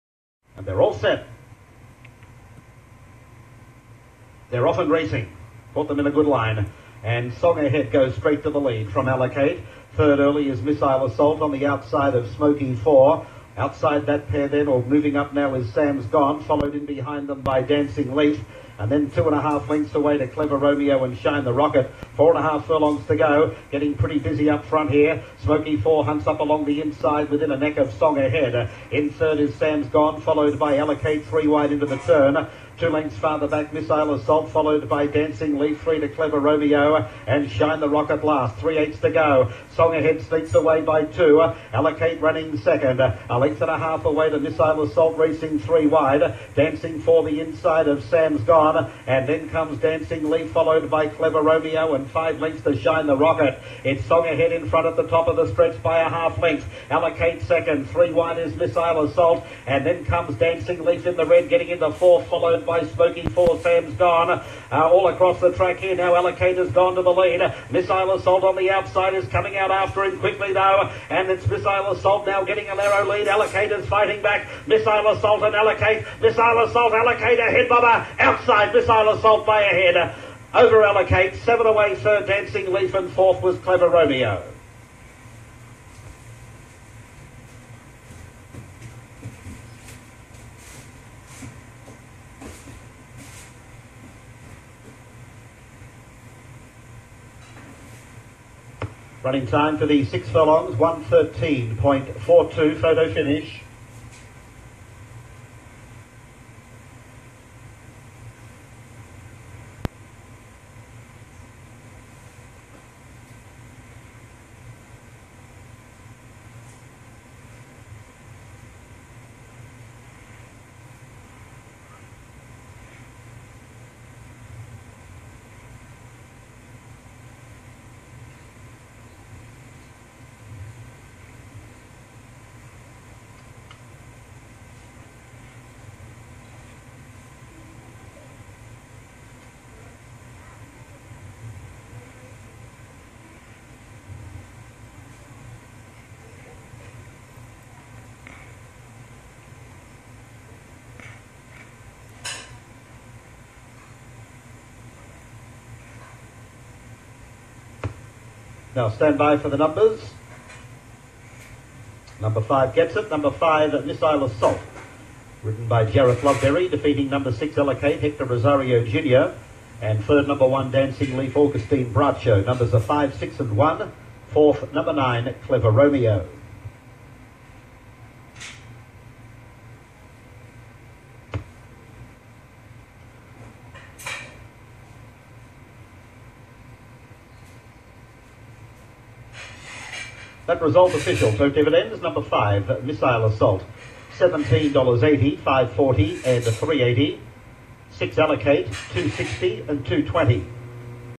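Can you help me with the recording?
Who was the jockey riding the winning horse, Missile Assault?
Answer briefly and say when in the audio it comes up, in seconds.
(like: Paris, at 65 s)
Jareth Loveberry, at 165 s.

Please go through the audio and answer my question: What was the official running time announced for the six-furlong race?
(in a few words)
1:13.42.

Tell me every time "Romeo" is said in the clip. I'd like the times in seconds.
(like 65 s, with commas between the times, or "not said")
20 s, 36 s, 51 s, 83 s, 175 s.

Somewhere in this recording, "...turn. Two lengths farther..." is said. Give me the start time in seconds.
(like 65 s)
31 s.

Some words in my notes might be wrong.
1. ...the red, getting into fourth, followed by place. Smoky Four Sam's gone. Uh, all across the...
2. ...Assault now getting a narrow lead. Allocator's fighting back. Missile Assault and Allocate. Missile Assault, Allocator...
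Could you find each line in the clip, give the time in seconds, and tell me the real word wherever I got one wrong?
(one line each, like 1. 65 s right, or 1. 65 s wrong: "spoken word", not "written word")
1. 61 s right
2. 71 s right.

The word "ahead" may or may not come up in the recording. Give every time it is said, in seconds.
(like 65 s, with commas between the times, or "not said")
7 s, 28 s, 39 s, 54 s.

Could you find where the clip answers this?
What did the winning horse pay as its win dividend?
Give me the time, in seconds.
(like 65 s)
194 s.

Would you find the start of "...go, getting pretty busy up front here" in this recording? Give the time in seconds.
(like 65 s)
23 s.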